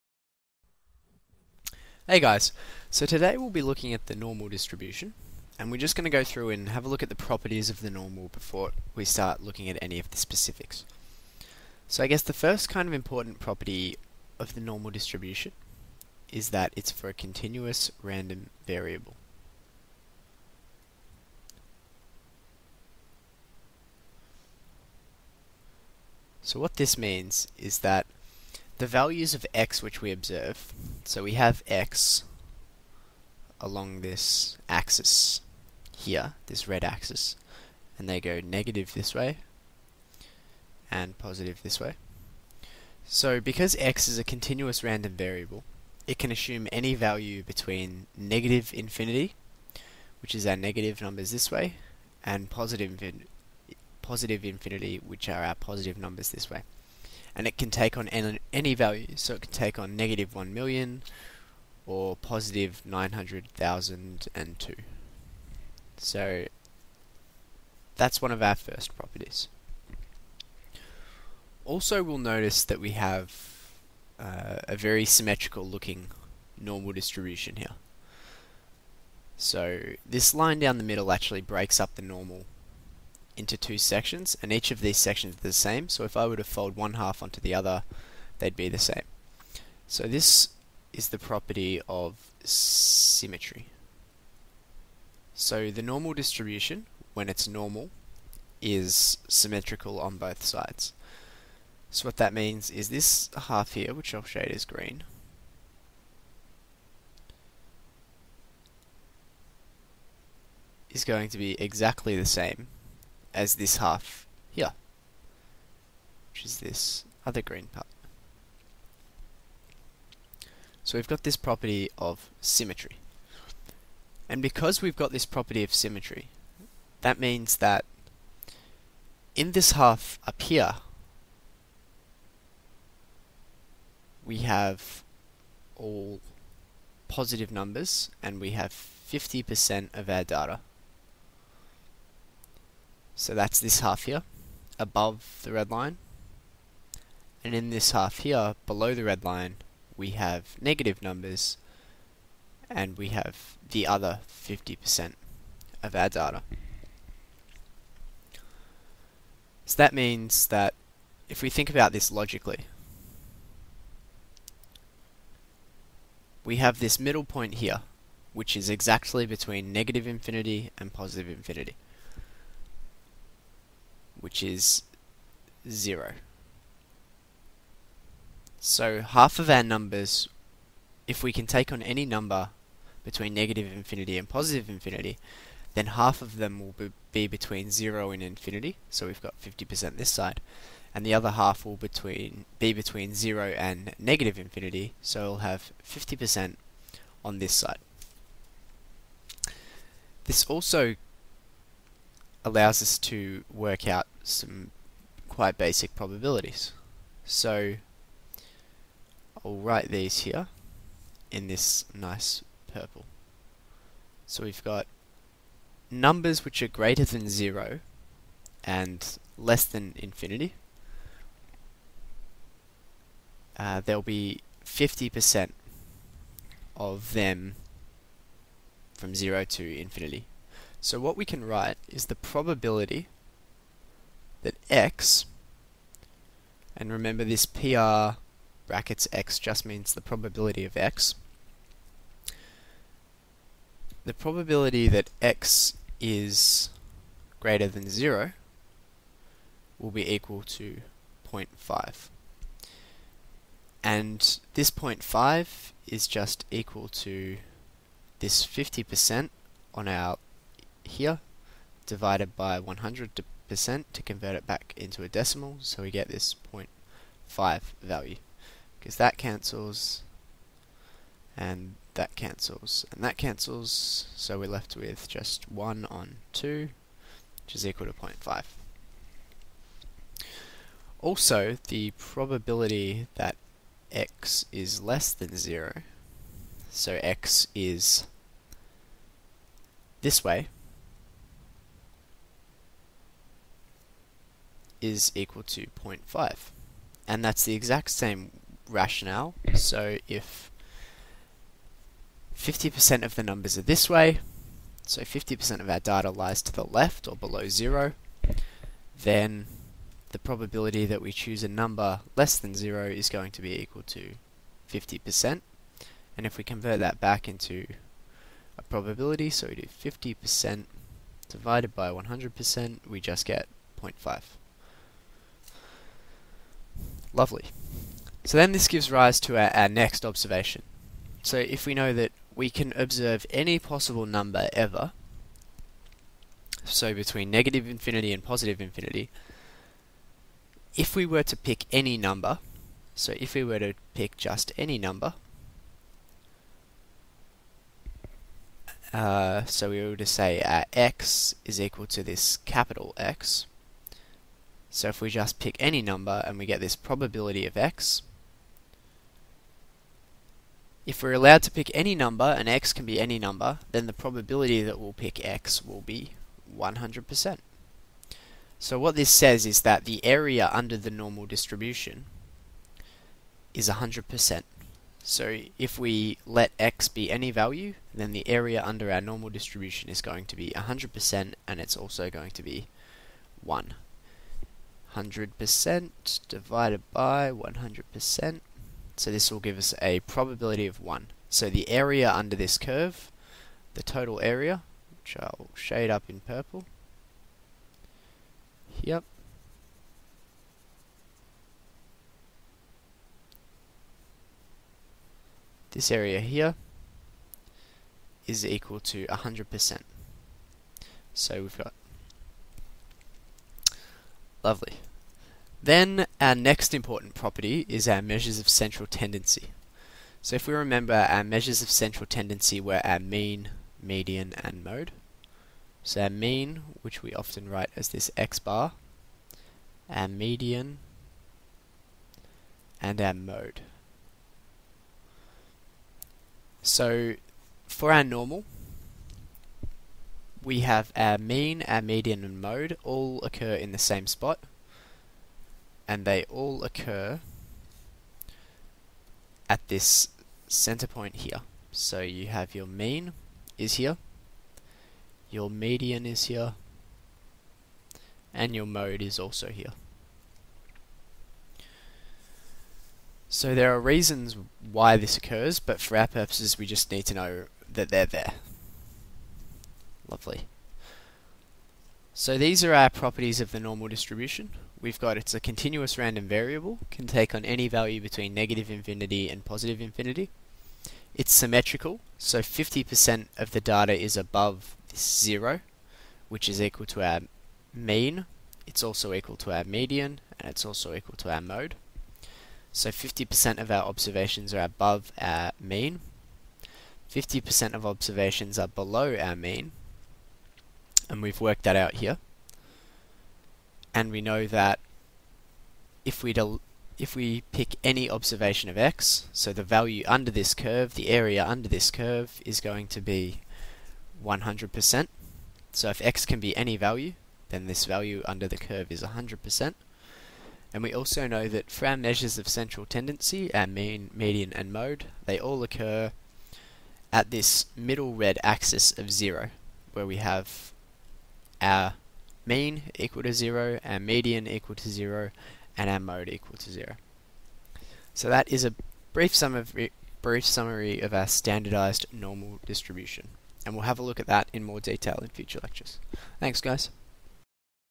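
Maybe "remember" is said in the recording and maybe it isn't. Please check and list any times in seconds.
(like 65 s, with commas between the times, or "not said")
236 s, 420 s.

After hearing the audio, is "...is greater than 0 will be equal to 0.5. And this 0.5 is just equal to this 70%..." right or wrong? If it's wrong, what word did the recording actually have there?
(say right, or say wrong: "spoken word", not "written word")
wrong: "50", not "70".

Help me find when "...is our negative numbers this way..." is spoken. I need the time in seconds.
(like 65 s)
50 s.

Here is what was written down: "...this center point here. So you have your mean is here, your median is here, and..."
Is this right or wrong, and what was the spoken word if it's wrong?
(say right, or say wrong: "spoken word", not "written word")
right.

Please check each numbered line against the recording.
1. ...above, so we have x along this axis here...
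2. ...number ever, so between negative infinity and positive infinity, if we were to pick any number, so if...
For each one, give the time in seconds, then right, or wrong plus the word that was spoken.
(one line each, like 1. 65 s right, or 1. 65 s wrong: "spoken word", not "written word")
1. 30 s wrong: "observe", not "above"
2. 334 s right.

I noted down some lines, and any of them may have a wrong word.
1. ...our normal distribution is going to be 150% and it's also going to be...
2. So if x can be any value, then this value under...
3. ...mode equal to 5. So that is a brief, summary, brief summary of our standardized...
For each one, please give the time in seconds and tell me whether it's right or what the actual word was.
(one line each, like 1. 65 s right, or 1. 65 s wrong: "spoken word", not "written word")
1. 378 s wrong: "100", not "150"
2. 515 s right
3. 535 s wrong: "0", not "5".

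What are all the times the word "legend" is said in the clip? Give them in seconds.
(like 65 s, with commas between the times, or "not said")
not said.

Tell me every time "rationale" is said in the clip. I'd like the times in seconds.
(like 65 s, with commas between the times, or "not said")
298 s.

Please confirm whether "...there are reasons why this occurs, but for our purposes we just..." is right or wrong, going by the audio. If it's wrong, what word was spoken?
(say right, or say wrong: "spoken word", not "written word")
right.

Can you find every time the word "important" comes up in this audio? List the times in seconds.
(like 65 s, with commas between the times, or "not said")
12 s, 416 s.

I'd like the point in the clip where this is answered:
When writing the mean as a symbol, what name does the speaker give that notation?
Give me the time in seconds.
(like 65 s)
428 s.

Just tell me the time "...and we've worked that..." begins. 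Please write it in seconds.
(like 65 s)
501 s.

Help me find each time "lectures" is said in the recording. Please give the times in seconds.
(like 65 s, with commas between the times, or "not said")
545 s.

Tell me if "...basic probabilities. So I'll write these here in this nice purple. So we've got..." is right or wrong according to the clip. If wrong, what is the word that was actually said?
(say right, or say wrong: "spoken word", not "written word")
right.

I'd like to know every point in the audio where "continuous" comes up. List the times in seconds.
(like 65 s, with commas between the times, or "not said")
17 s, 44 s, 475 s.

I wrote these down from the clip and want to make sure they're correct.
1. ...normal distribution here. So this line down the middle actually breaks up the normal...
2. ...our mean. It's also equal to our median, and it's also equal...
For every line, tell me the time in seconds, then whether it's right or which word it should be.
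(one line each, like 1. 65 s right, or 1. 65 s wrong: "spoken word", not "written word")
1. 76 s right
2. 487 s right.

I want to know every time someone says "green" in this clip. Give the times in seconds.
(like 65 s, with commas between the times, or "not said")
104 s, 117 s.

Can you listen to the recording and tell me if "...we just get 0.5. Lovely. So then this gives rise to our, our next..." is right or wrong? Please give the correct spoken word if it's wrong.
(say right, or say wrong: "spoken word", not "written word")
right.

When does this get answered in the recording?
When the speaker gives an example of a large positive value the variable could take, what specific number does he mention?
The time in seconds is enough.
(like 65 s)
62 s.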